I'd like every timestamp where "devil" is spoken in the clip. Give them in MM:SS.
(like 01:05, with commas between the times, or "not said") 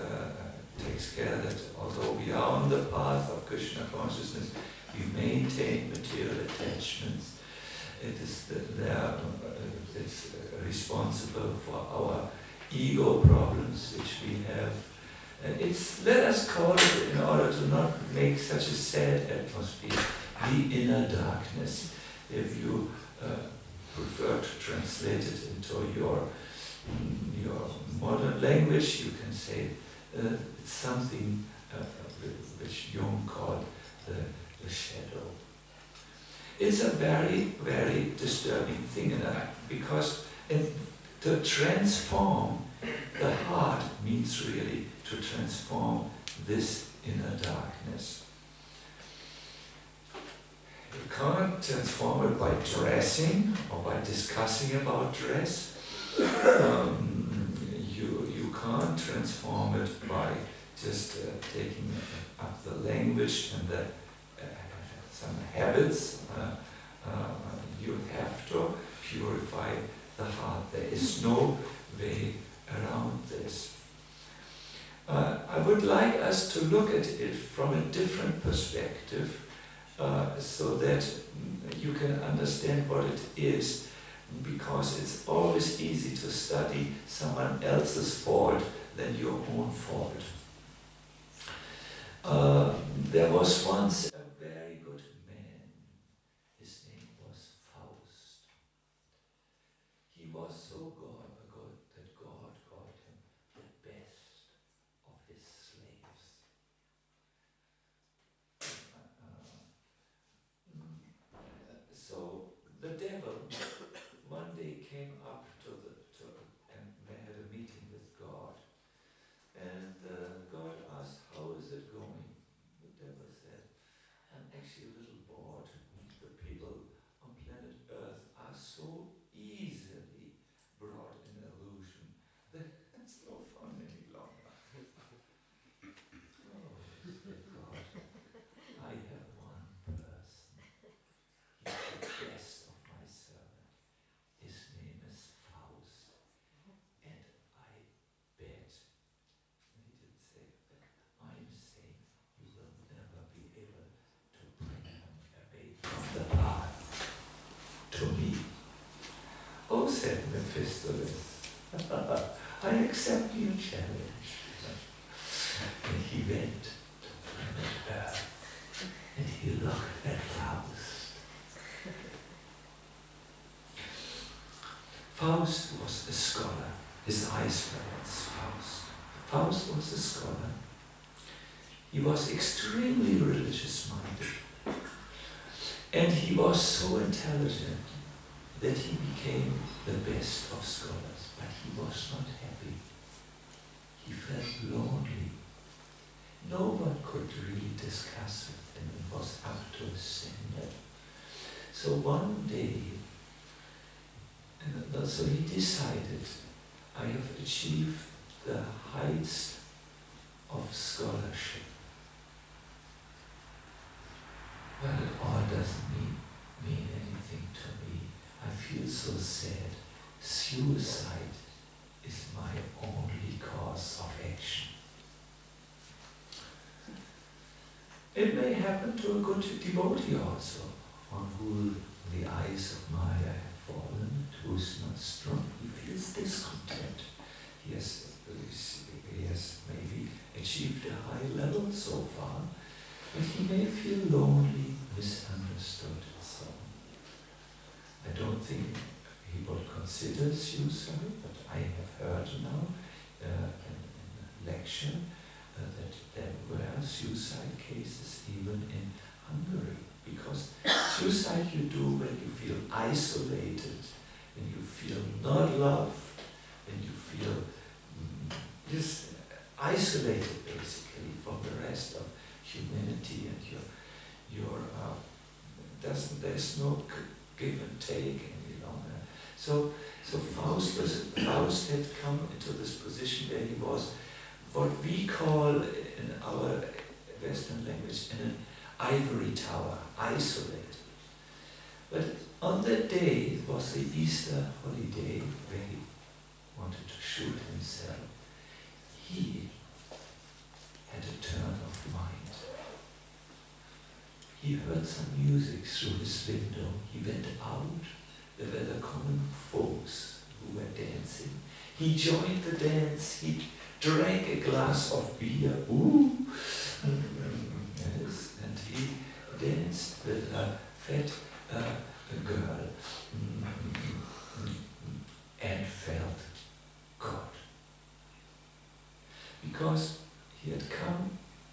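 01:52, 02:03.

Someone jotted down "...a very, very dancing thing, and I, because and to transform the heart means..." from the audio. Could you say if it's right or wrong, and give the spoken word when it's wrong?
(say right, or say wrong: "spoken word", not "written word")
wrong: "disturbing", not "dancing".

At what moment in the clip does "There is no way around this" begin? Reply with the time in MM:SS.
01:10.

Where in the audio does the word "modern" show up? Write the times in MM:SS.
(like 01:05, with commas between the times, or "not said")
00:27.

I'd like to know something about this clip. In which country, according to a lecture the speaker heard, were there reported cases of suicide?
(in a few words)
Hungary.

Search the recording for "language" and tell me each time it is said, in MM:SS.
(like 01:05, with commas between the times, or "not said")
00:28, 01:02, 04:47.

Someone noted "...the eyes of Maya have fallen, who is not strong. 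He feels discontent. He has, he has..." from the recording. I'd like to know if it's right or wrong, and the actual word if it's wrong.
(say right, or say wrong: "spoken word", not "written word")
right.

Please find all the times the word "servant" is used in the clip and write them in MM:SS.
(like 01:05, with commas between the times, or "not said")
02:23.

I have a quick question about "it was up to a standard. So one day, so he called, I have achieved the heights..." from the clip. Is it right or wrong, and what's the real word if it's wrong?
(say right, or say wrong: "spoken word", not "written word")
wrong: "decided", not "called".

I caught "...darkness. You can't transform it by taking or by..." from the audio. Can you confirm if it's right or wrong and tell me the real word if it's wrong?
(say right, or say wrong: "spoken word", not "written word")
wrong: "dressing", not "taking".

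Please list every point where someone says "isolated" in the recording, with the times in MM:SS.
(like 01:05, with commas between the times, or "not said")
04:22, 04:29, 04:49.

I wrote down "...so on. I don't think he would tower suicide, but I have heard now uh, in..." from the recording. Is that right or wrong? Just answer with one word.
wrong.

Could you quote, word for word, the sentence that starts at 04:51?
But on that day it was the Easter holiday where he wanted to shoot himself.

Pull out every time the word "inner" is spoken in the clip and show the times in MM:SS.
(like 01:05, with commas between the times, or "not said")
00:20, 00:47.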